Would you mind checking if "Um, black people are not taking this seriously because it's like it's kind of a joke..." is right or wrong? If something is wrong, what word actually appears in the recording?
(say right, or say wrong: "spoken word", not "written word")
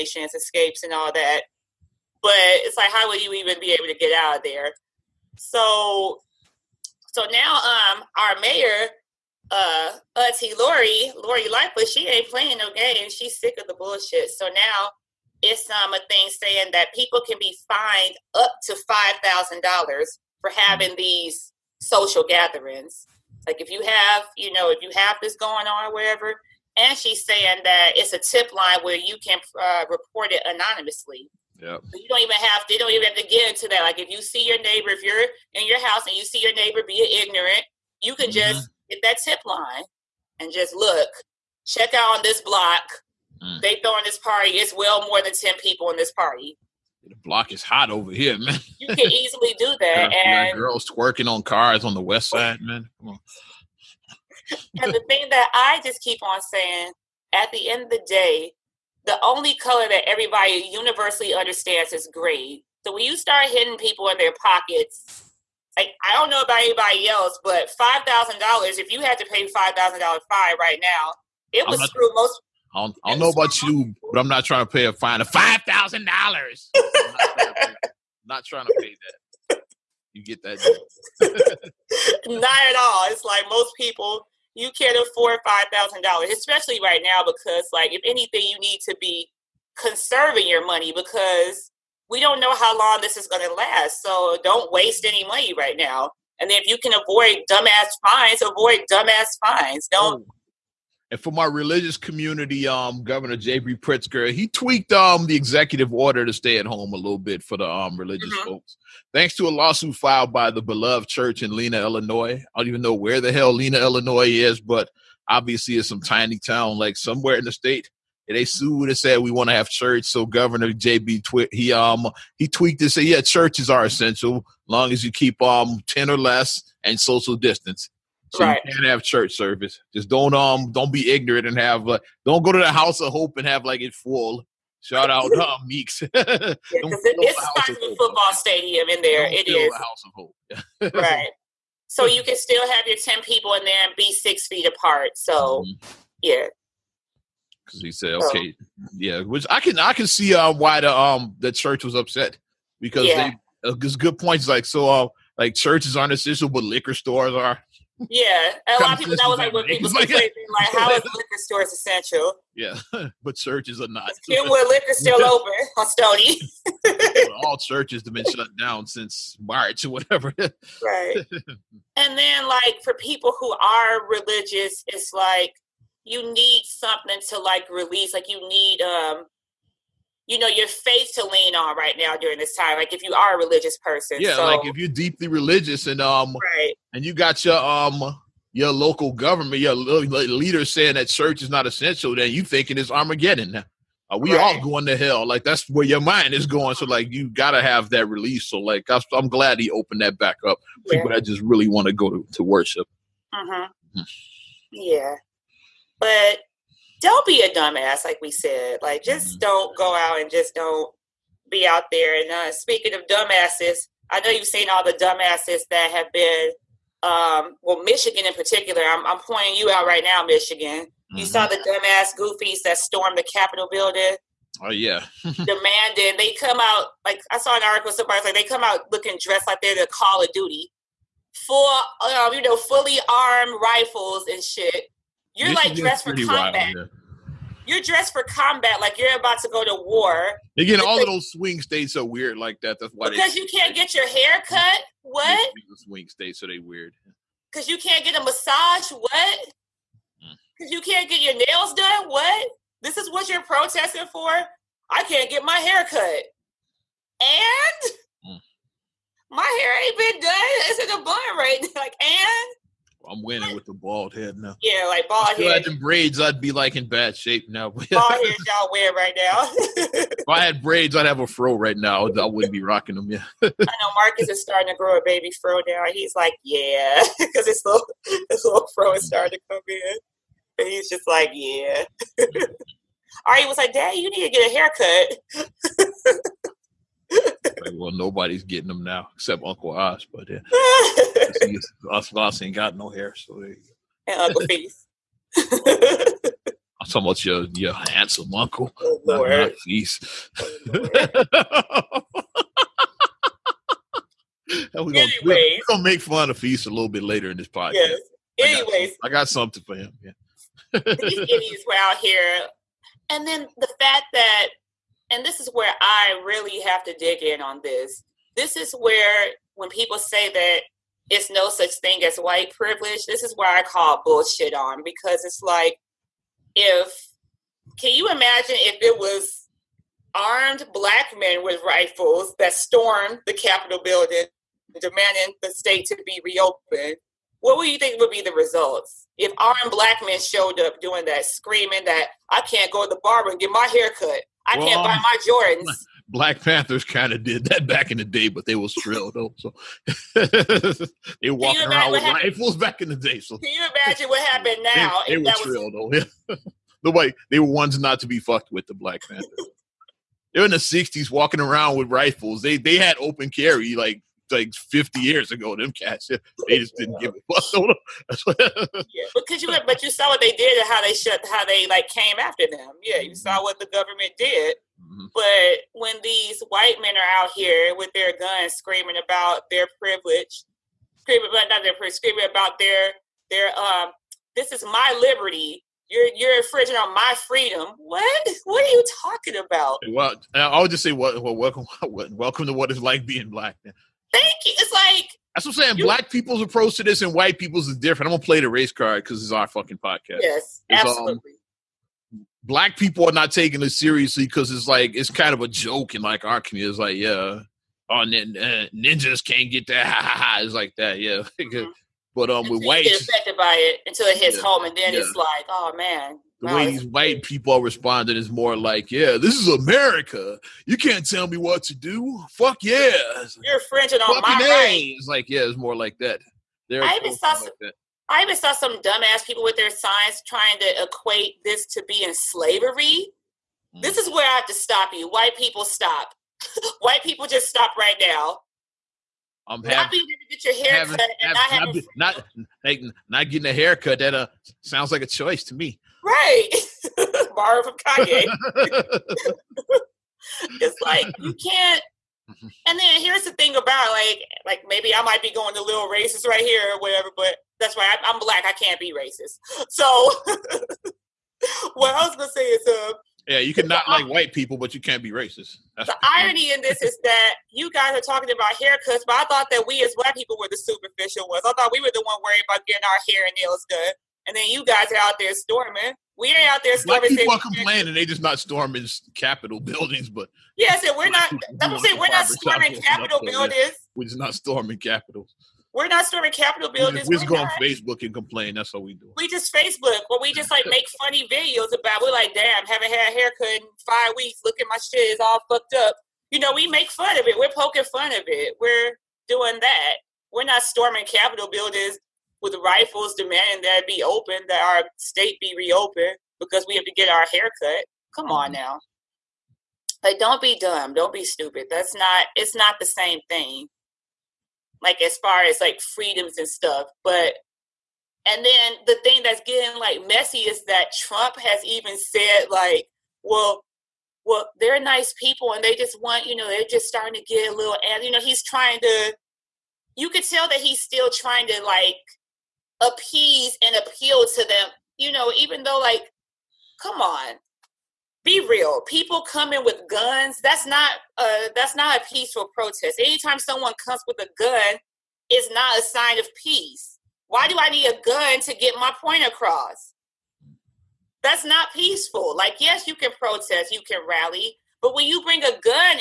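right.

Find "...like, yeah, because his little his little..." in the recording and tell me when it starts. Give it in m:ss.
4:36.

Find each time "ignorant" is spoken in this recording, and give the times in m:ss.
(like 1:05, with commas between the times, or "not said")
0:37, 2:11.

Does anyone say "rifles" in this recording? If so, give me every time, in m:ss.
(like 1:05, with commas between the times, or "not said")
3:53, 5:31, 5:52, 6:01, 8:22.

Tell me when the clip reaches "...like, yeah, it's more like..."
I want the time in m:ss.
7:05.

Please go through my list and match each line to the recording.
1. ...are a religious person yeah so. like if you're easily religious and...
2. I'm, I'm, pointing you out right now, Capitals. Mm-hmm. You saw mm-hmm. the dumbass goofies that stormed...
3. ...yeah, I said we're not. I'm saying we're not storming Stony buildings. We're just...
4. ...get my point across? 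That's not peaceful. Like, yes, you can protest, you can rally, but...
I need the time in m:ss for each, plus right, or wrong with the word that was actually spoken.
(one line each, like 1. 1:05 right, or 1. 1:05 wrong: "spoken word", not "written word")
1. 3:03 wrong: "deeply", not "easily"
2. 3:38 wrong: "Michigan", not "Capitals"
3. 8:00 wrong: "Capitol", not "Stony"
4. 9:08 right.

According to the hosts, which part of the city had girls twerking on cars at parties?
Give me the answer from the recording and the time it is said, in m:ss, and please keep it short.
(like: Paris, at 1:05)
west side, at 0:52.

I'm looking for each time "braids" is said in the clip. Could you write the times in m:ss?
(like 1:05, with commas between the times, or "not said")
4:25, 4:30.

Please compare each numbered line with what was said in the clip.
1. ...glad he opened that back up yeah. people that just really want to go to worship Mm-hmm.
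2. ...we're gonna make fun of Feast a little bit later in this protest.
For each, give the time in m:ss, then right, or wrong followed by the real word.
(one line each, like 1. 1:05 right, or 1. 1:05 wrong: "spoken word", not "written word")
1. 3:19 right
2. 5:05 wrong: "podcast", not "protest".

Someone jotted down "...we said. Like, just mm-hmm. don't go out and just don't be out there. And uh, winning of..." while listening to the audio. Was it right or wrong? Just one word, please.
wrong.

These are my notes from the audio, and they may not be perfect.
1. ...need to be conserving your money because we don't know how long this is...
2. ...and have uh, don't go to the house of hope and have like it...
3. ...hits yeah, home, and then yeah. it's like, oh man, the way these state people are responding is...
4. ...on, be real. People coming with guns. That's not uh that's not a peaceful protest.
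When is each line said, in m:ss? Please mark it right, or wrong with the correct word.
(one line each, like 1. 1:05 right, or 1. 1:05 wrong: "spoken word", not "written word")
1. 1:28 right
2. 2:11 right
3. 6:54 wrong: "white", not "state"
4. 8:57 right.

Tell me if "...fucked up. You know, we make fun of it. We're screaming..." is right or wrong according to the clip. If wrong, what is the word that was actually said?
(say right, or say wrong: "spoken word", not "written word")
wrong: "poking", not "screaming".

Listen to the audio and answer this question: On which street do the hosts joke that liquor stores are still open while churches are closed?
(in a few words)
Stony.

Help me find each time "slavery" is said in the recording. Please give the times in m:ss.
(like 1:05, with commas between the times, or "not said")
7:12.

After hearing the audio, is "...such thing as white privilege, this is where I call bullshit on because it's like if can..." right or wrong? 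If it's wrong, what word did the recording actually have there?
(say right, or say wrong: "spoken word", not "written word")
right.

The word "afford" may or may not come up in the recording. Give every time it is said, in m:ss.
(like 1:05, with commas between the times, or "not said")
1:25.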